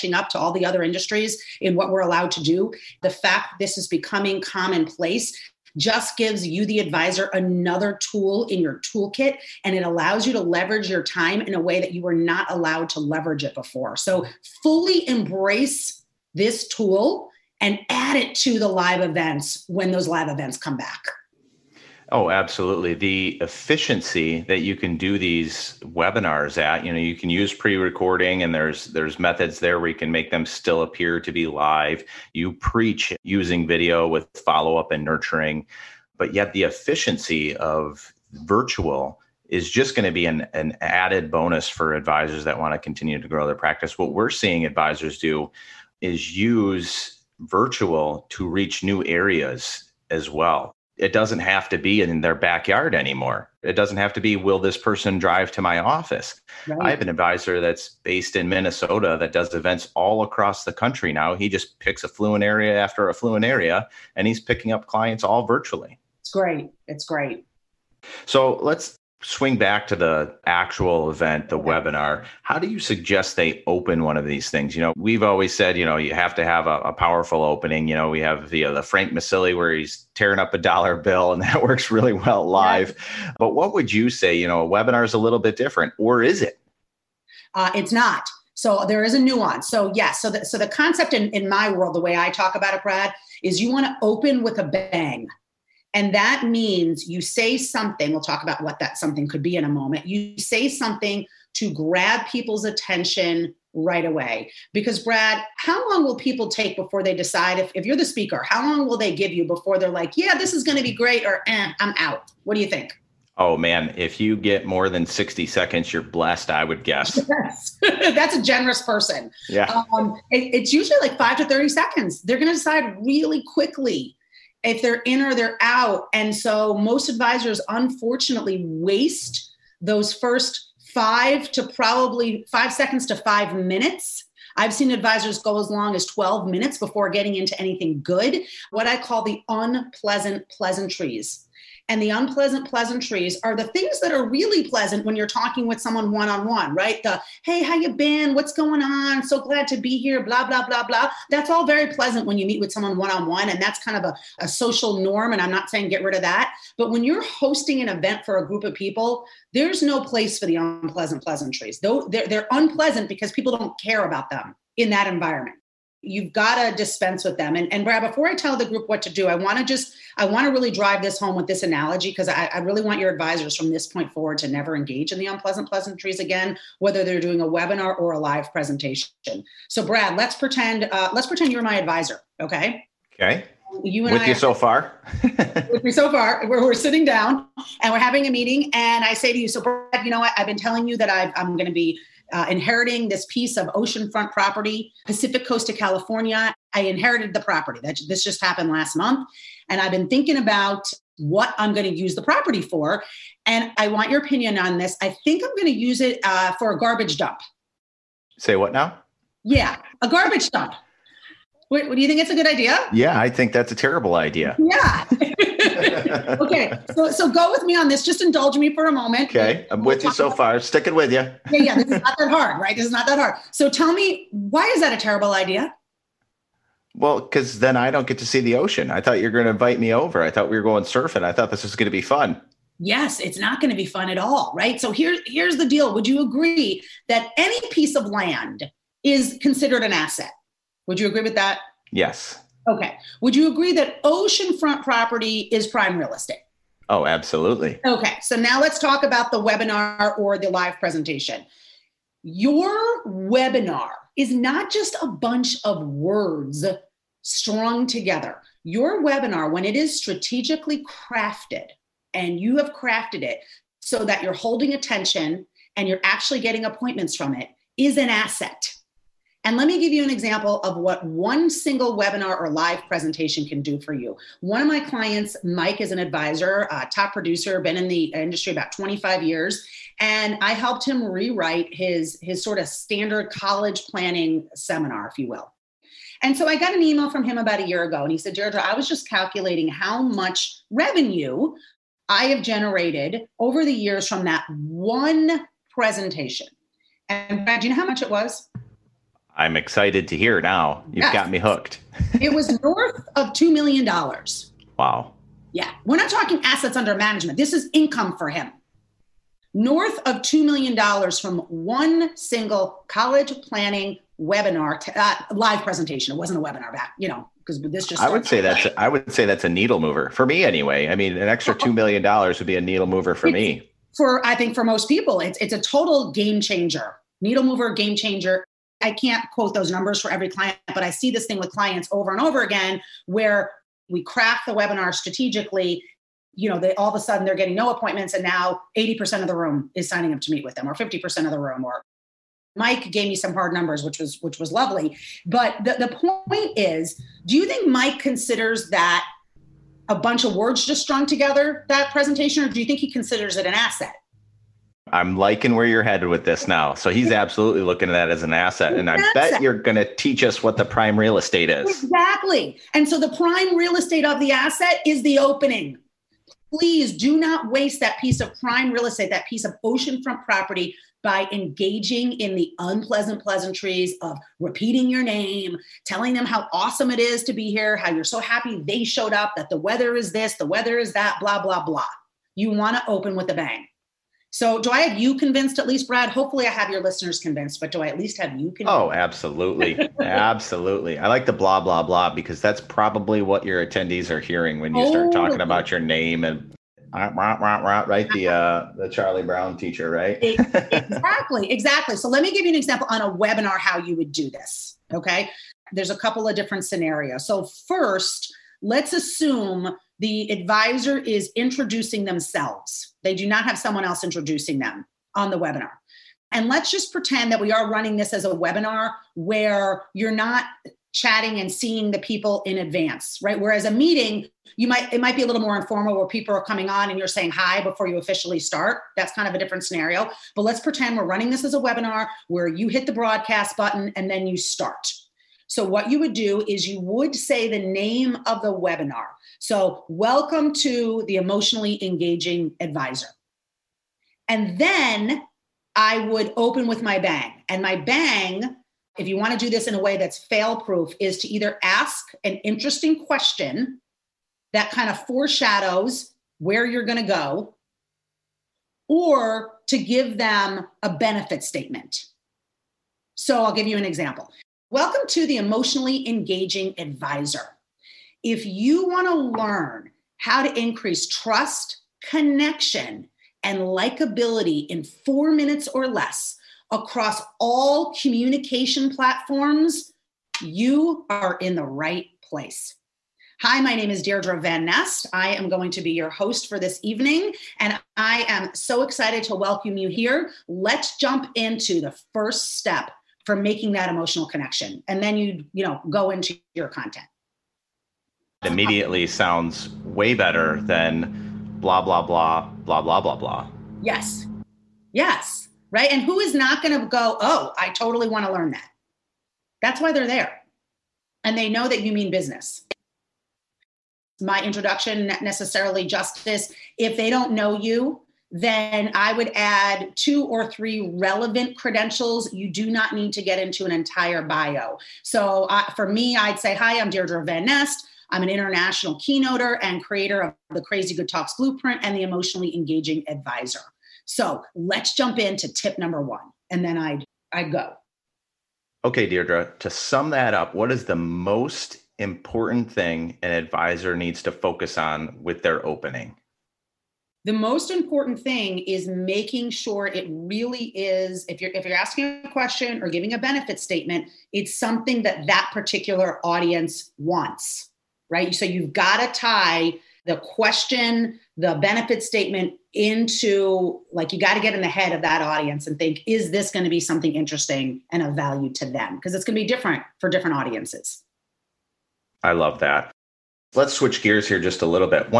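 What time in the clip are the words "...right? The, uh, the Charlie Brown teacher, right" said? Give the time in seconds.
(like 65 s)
396 s.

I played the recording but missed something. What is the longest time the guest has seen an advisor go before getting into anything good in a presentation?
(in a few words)
12 minutes.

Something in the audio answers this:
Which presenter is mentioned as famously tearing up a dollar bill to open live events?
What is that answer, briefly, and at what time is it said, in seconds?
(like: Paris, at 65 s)
Frank Maselli, at 78 s.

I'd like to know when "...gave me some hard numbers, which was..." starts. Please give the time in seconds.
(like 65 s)
342 s.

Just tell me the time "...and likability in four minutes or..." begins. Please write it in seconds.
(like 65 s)
473 s.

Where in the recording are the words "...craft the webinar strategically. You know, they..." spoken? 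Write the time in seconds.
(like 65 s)
334 s.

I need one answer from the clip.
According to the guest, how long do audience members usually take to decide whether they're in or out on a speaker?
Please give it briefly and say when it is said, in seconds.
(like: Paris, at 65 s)
5 to 30 seconds, at 121 s.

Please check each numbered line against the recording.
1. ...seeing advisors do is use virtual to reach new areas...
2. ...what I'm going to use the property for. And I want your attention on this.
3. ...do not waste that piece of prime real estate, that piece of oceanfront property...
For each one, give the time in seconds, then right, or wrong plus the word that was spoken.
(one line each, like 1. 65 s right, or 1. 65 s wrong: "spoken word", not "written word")
1. 44 s right
2. 201 s wrong: "opinion", not "attention"
3. 366 s right.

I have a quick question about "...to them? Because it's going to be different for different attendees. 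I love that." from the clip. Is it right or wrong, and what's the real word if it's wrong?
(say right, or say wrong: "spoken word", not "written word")
wrong: "audiences", not "attendees".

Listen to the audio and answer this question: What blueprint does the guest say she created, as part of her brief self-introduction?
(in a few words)
Crazy Good Talks Blueprint.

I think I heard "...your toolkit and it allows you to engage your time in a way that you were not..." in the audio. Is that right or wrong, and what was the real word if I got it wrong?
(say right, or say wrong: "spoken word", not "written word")
wrong: "leverage", not "engage".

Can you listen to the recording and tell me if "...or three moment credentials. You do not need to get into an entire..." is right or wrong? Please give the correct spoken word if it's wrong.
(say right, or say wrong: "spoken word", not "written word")
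wrong: "relevant", not "moment".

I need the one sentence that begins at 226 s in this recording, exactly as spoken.
Well, because then I don't get to see the ocean.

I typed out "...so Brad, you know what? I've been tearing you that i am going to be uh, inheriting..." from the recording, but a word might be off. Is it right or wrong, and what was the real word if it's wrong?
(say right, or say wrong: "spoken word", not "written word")
wrong: "telling", not "tearing".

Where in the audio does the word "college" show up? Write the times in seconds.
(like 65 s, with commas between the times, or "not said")
283 s, 312 s.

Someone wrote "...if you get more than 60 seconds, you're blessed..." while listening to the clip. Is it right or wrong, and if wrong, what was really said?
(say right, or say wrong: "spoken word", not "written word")
right.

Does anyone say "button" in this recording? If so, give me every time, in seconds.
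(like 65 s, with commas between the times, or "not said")
433 s.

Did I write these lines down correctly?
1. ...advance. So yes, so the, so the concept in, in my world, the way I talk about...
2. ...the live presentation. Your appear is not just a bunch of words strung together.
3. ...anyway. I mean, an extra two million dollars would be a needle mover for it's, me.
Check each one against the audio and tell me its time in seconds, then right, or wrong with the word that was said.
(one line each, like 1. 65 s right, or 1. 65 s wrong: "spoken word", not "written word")
1. 89 s wrong: "nuance", not "advance"
2. 250 s wrong: "webinar", not "appear"
3. 320 s right.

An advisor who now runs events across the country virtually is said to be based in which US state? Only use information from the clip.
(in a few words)
Minnesota.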